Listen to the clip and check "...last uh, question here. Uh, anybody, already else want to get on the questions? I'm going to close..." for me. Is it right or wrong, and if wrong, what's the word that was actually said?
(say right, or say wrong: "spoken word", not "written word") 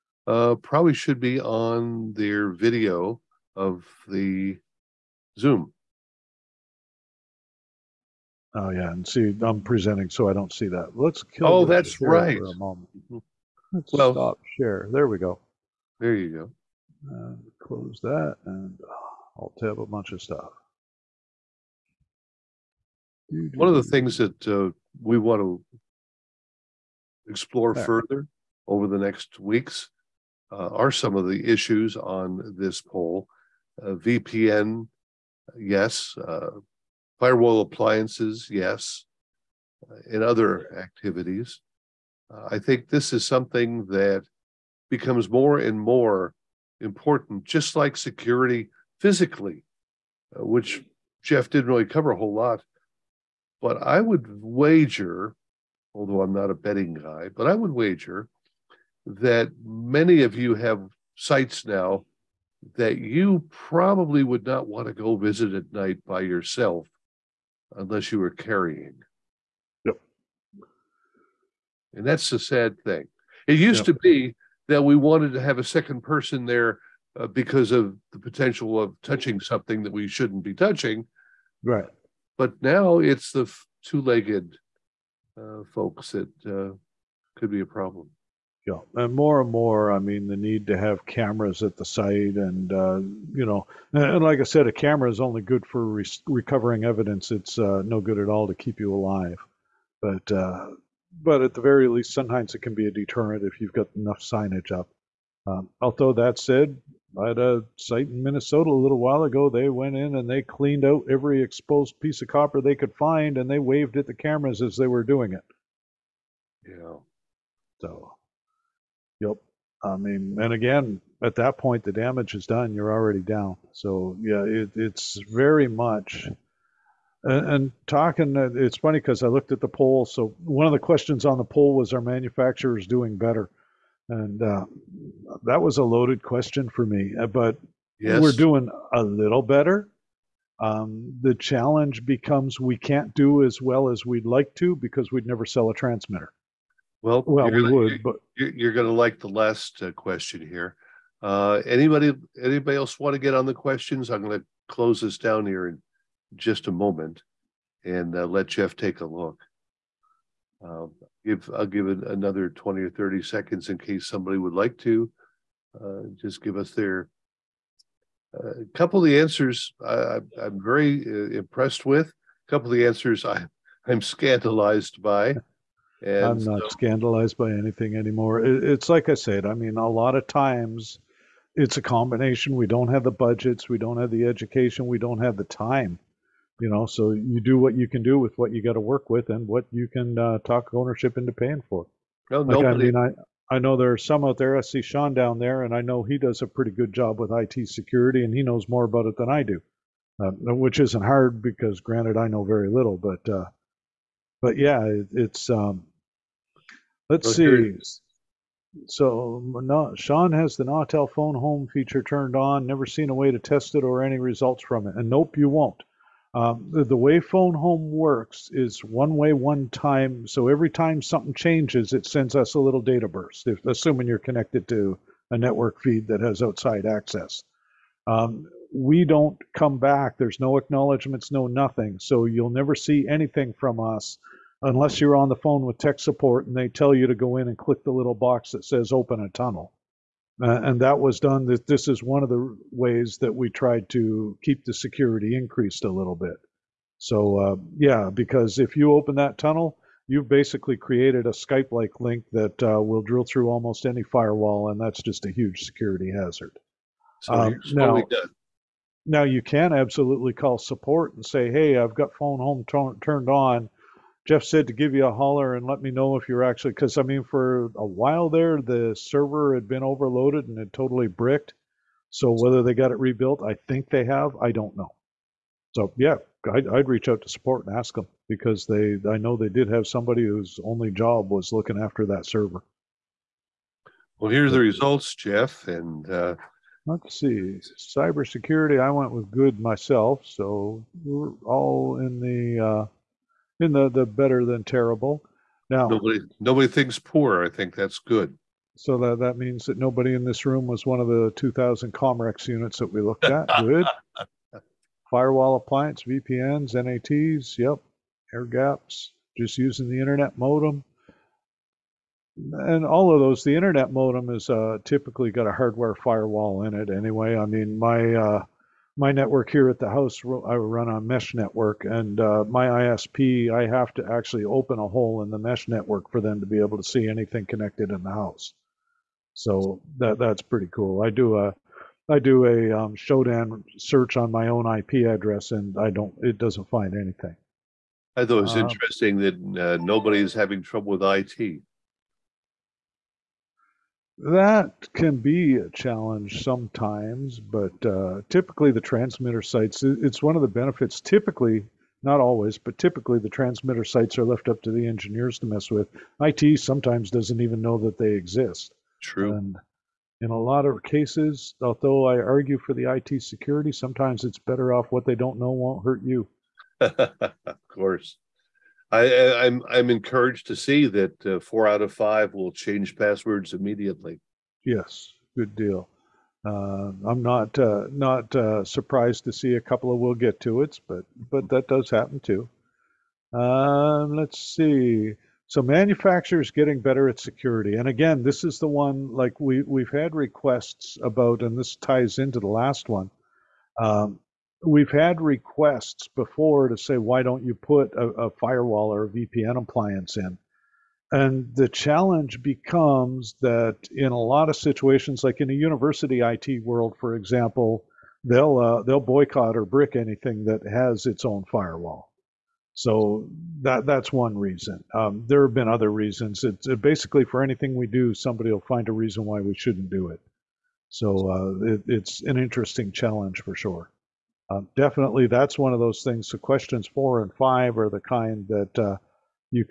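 wrong: "anybody", not "already".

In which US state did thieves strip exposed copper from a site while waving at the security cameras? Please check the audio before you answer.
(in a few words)
Minnesota.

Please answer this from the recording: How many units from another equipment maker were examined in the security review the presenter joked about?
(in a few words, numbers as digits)
2,000.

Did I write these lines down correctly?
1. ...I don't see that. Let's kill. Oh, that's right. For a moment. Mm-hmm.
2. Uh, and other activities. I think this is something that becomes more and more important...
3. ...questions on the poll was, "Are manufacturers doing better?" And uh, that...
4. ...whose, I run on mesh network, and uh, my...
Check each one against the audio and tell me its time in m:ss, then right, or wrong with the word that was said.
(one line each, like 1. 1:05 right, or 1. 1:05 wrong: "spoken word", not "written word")
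1. 0:10 right
2. 0:39 right
3. 2:10 right
4. 5:19 wrong: "house", not "whose".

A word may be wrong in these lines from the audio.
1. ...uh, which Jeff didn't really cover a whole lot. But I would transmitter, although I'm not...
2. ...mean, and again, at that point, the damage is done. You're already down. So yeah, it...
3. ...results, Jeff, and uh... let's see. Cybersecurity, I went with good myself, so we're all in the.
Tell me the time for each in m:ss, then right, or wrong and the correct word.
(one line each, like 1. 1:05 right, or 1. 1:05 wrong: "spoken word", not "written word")
1. 0:50 wrong: "wager", not "transmitter"
2. 1:59 right
3. 4:44 right.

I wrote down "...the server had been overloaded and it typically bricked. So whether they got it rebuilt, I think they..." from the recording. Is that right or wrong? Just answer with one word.
wrong.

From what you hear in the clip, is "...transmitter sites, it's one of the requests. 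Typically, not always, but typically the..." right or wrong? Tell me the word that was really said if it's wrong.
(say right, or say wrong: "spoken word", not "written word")
wrong: "benefits", not "requests".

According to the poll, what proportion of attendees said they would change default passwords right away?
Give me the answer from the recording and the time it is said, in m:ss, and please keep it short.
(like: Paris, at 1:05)
4 out of 5, at 6:11.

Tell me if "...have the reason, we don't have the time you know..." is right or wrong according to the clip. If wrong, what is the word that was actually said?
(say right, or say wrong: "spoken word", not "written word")
wrong: "education", not "reason".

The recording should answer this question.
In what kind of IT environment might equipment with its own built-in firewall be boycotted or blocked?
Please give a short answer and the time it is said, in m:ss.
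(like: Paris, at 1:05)
University, at 6:45.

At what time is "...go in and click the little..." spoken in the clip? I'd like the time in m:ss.
3:57.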